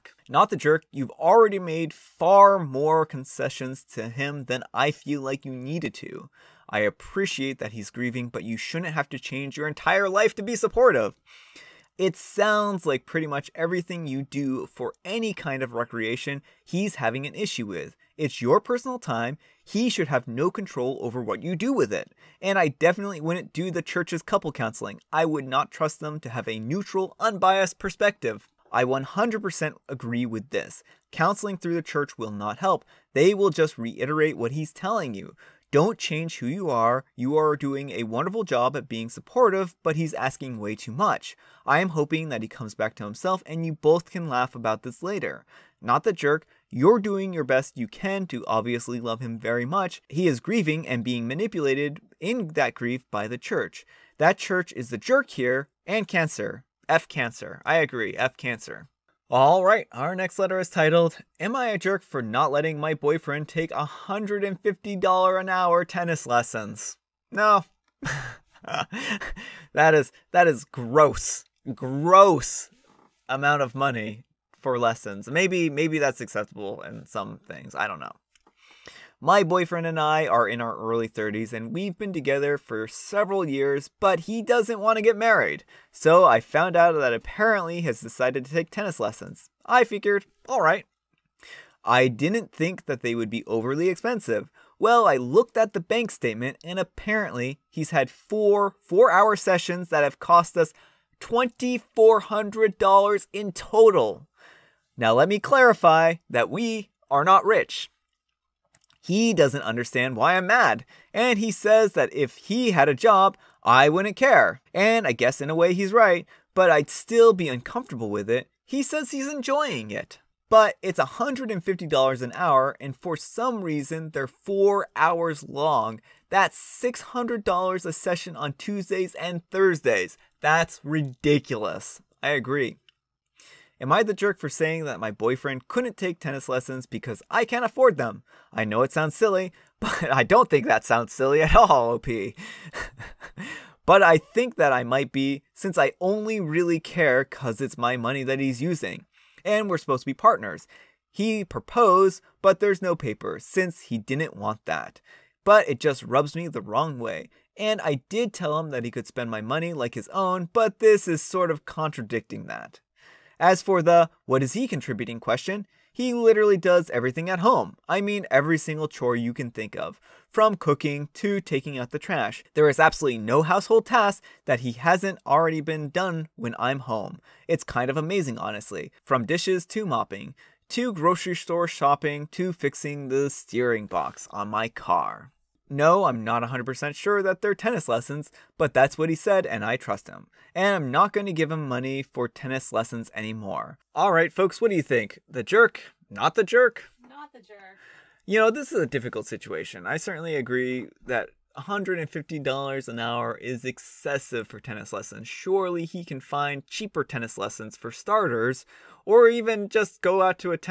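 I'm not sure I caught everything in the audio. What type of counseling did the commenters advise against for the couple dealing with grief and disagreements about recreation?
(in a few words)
The church's couple counseling.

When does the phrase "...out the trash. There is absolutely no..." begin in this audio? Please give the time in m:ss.
2:51.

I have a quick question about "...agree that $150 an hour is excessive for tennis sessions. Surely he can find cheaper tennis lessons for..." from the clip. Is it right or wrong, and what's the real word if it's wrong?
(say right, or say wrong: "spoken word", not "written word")
wrong: "lessons", not "sessions".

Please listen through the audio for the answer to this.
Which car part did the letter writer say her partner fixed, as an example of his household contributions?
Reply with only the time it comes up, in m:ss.
3:03.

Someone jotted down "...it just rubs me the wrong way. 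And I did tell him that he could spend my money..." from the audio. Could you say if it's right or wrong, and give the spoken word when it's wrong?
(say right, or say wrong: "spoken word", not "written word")
right.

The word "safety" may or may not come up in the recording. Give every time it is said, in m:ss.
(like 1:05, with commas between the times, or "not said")
not said.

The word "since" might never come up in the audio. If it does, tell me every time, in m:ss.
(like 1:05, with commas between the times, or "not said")
2:25, 2:33.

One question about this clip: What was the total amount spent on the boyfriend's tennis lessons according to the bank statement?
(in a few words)
$2400.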